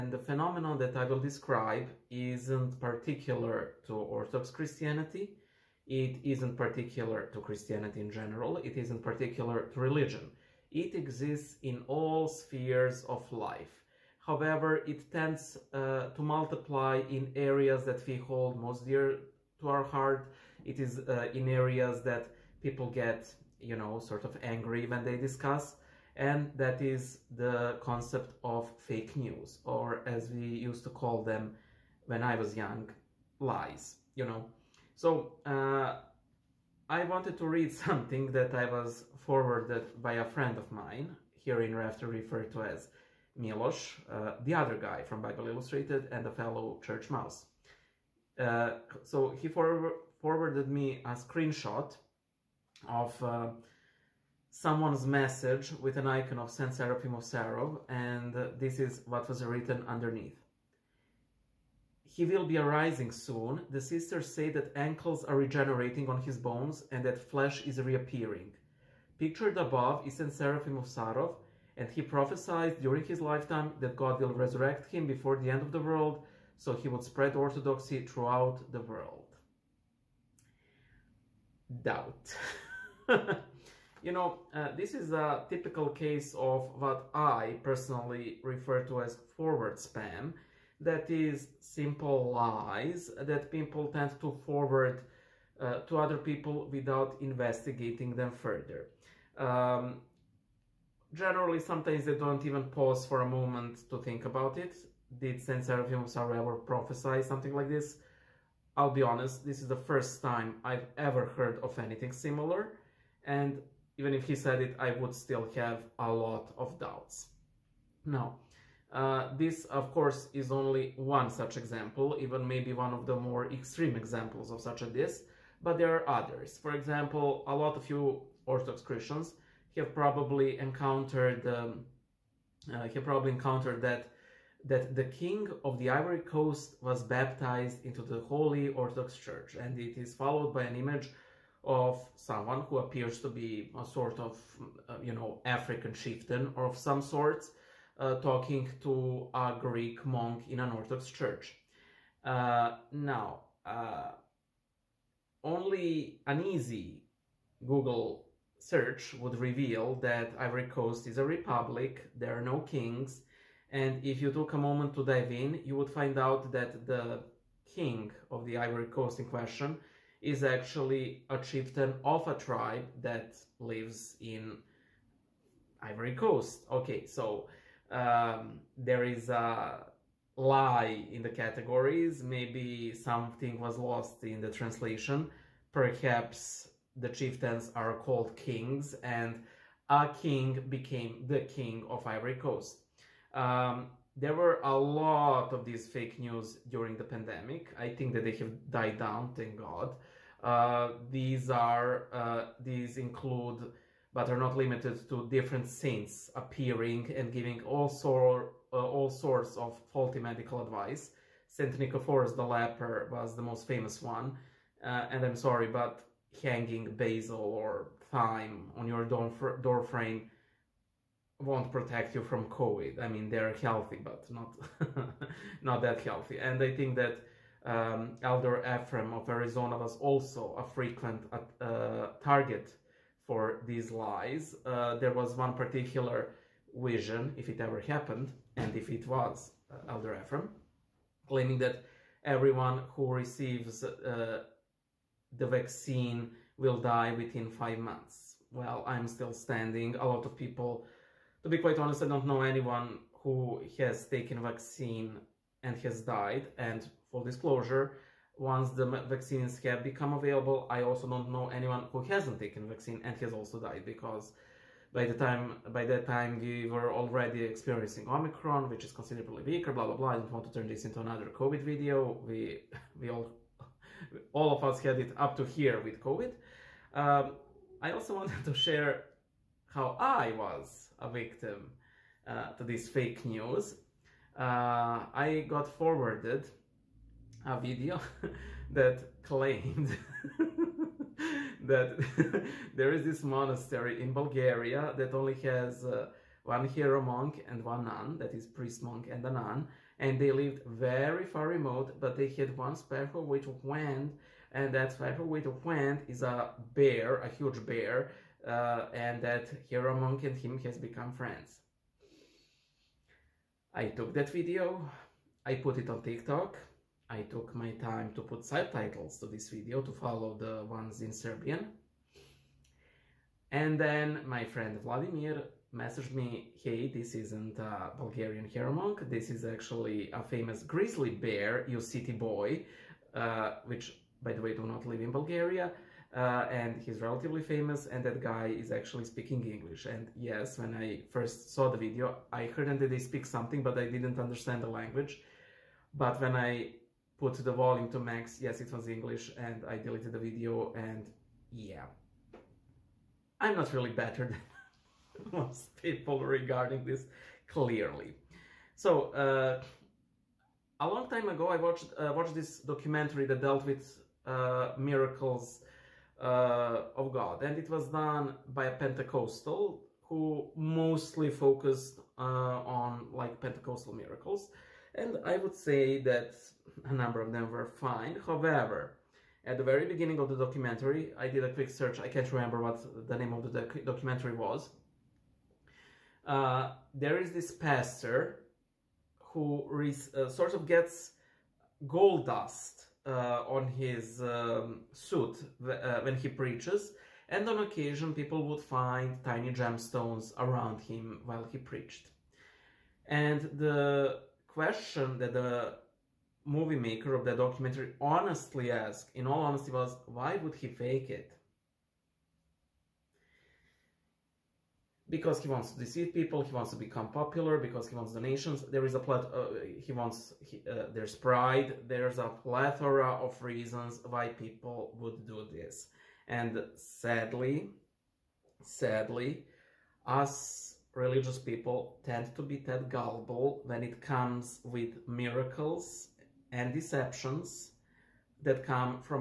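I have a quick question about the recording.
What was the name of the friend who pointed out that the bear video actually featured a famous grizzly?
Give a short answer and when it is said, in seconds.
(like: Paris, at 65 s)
Vladimir, at 324 s.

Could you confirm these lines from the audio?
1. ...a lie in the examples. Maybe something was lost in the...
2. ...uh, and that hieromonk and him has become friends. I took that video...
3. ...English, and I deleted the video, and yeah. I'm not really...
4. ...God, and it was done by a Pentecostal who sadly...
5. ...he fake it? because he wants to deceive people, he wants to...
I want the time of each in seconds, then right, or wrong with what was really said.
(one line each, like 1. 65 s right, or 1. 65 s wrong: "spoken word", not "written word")
1. 179 s wrong: "categories", not "examples"
2. 308 s right
3. 348 s right
4. 367 s wrong: "mostly", not "sadly"
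5. 410 s right.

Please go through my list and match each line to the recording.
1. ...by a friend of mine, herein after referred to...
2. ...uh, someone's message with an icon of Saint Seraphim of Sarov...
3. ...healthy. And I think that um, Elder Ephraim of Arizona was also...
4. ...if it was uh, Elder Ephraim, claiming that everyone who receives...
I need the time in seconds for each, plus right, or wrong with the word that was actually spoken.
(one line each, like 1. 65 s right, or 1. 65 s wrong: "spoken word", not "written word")
1. 40 s right
2. 53 s right
3. 226 s right
4. 238 s right.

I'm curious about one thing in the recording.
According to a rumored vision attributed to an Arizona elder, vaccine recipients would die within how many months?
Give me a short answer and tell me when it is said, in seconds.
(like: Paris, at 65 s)
5, at 247 s.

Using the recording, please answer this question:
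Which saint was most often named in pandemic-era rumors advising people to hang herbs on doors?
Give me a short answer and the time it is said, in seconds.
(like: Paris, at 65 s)
Saint Nicephorus the leper, at 211 s.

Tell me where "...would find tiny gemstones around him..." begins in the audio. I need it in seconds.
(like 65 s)
398 s.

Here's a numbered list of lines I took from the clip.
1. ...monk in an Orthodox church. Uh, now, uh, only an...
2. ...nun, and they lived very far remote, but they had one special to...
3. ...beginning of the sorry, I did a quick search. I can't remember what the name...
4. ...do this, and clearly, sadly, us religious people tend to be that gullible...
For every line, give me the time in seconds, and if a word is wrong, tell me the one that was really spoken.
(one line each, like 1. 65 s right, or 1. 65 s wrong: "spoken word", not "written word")
1. 150 s right
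2. 299 s right
3. 379 s wrong: "documentary", not "sorry"
4. 425 s wrong: "sadly", not "clearly".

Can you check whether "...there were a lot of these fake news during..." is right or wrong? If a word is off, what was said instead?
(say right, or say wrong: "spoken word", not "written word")
right.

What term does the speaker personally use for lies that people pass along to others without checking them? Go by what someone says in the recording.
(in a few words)
forward spam.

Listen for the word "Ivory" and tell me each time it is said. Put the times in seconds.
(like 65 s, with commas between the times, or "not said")
135 s, 160 s, 168 s, 175 s, 192 s.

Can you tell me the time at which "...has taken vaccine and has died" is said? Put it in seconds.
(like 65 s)
253 s.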